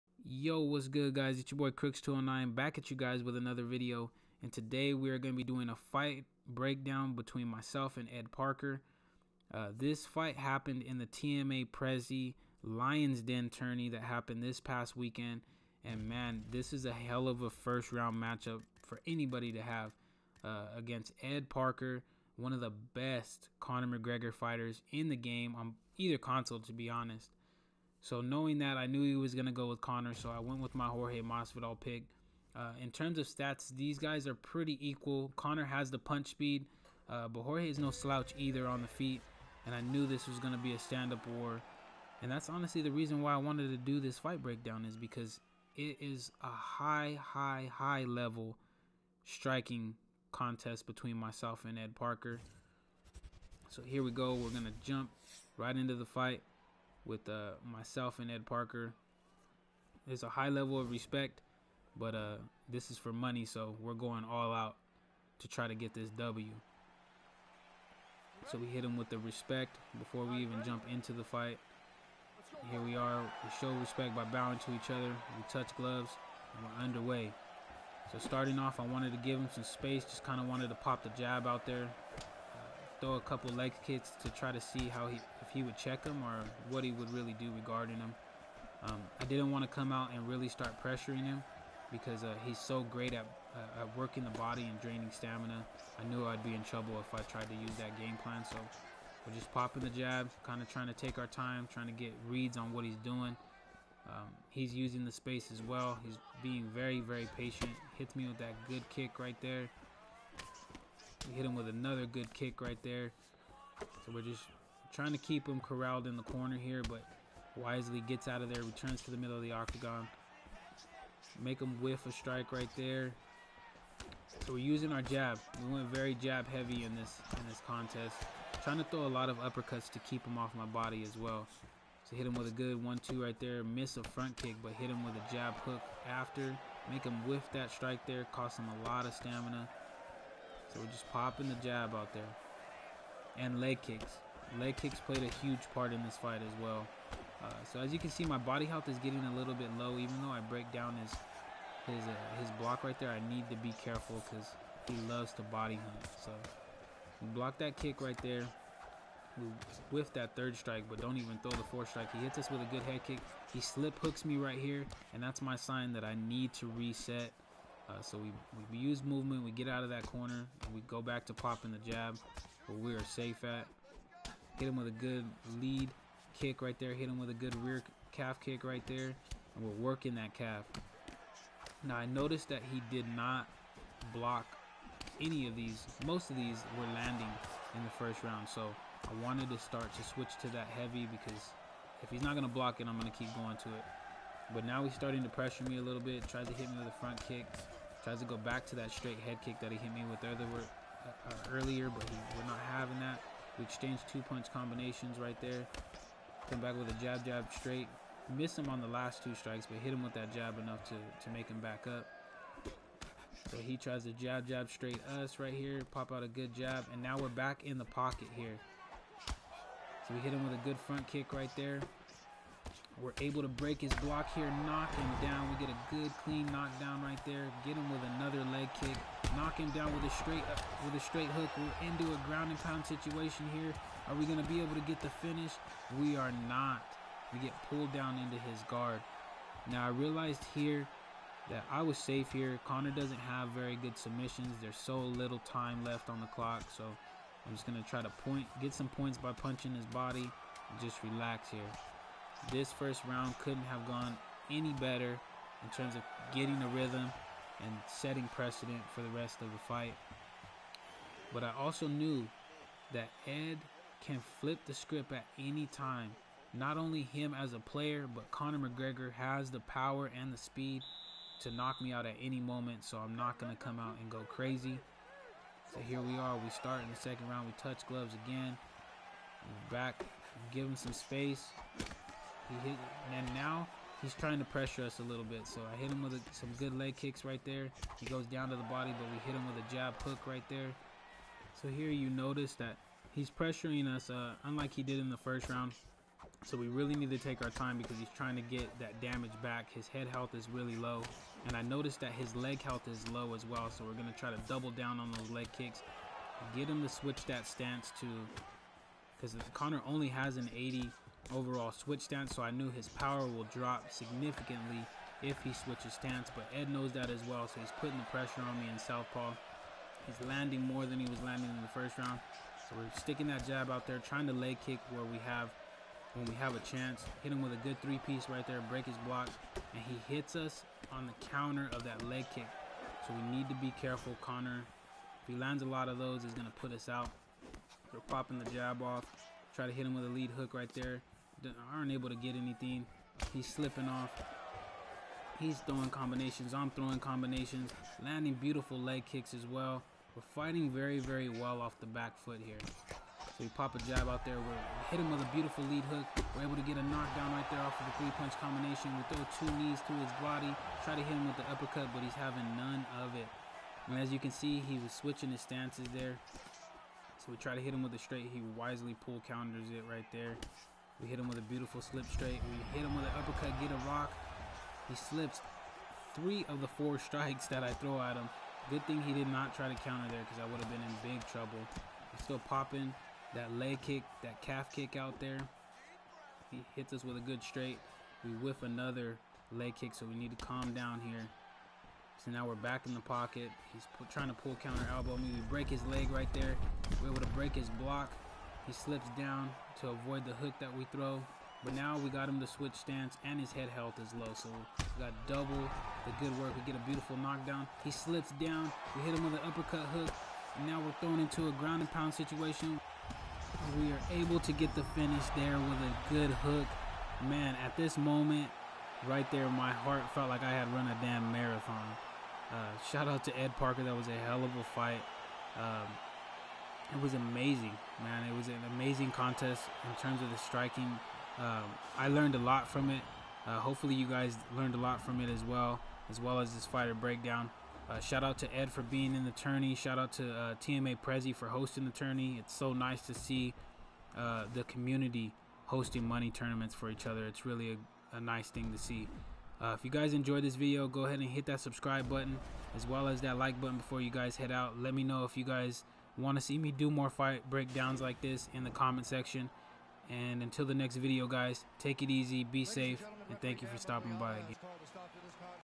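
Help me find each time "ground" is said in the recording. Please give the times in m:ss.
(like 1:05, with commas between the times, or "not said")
3:52, 6:51.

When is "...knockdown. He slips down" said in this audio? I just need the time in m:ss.
6:47.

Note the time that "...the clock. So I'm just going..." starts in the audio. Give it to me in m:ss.
4:06.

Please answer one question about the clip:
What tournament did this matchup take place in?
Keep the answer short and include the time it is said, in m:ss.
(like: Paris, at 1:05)
TMA Prezi Lions Den, at 0:11.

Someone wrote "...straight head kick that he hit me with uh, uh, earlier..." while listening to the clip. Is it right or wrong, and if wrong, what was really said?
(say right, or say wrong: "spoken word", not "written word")
right.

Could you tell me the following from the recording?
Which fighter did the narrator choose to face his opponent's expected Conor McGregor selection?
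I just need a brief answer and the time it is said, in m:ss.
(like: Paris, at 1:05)
Jorge Masvidal, at 0:30.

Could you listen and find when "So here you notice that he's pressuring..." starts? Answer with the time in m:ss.
4:51.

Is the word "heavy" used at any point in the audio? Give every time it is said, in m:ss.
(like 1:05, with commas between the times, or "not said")
2:06, 3:10.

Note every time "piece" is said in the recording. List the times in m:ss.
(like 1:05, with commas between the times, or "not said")
5:27.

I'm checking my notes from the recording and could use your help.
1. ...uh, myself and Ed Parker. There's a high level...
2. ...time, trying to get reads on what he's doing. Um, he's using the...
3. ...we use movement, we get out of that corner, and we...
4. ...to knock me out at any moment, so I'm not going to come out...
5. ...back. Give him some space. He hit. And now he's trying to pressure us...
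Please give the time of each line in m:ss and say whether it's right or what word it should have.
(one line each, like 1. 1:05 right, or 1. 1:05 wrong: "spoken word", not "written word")
1. 0:57 right
2. 1:41 right
3. 2:48 right
4. 4:31 right
5. 4:39 right.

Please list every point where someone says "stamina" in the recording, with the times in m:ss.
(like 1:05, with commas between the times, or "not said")
1:35, 2:19.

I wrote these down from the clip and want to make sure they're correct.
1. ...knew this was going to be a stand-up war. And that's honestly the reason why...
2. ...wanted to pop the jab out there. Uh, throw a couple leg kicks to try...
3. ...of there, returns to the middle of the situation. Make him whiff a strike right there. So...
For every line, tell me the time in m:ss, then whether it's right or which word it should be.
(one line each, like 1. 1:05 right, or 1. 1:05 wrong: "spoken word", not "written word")
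1. 0:39 right
2. 1:20 right
3. 1:58 wrong: "octagon", not "situation".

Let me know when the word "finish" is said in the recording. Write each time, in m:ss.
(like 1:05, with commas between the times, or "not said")
3:55, 6:54.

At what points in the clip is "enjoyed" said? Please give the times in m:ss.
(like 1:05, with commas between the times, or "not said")
7:30.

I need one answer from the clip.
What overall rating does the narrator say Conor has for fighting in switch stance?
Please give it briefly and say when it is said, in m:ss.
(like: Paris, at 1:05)
80, at 5:10.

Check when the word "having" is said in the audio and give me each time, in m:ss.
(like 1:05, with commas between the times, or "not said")
3:22, 6:02.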